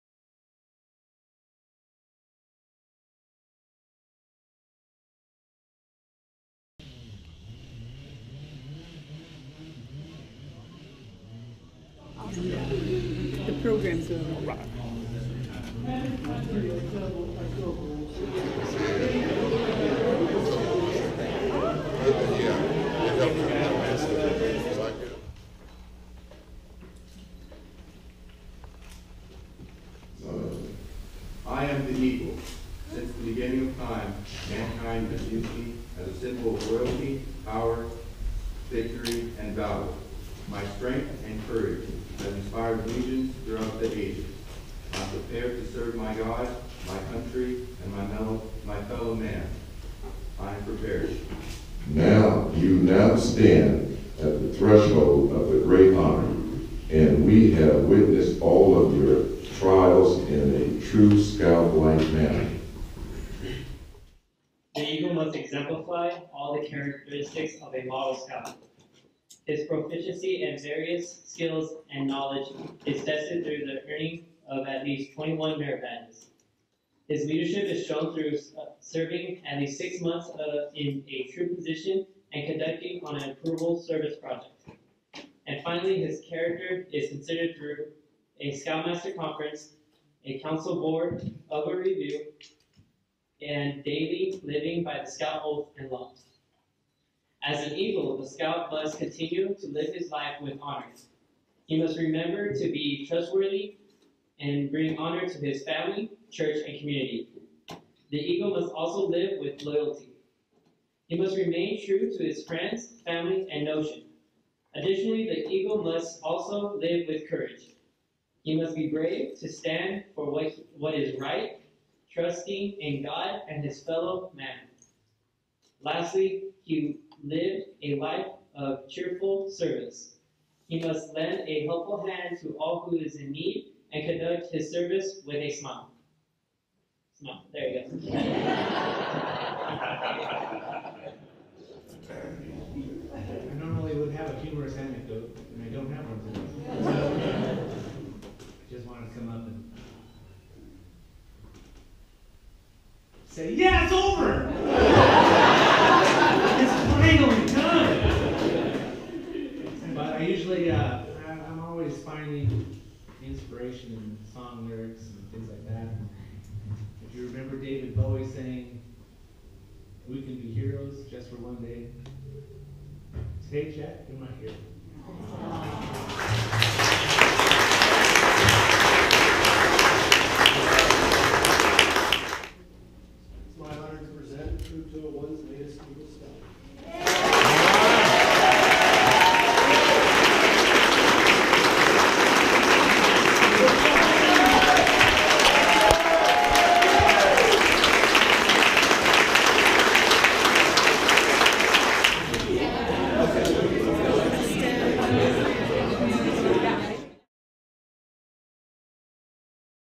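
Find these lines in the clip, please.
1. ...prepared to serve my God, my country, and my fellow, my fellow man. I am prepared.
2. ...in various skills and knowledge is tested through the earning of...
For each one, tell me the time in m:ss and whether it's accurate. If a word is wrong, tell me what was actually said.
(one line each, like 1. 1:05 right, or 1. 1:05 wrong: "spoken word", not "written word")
1. 0:45 right
2. 1:10 right.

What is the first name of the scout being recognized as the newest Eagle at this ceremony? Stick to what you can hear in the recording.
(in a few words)
Jack.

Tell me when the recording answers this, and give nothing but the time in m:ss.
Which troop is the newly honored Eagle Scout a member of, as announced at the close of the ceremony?
3:04.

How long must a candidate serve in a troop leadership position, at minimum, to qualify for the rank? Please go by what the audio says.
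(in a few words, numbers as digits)
six months.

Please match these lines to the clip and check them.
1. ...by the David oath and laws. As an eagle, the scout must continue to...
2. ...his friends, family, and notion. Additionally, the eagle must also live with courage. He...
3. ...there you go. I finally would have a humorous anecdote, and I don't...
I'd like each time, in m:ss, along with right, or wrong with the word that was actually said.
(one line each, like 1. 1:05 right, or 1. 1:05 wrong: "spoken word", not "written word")
1. 1:34 wrong: "Scout", not "David"
2. 1:52 right
3. 2:17 wrong: "normally", not "finally".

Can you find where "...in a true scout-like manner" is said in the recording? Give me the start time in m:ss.
1:00.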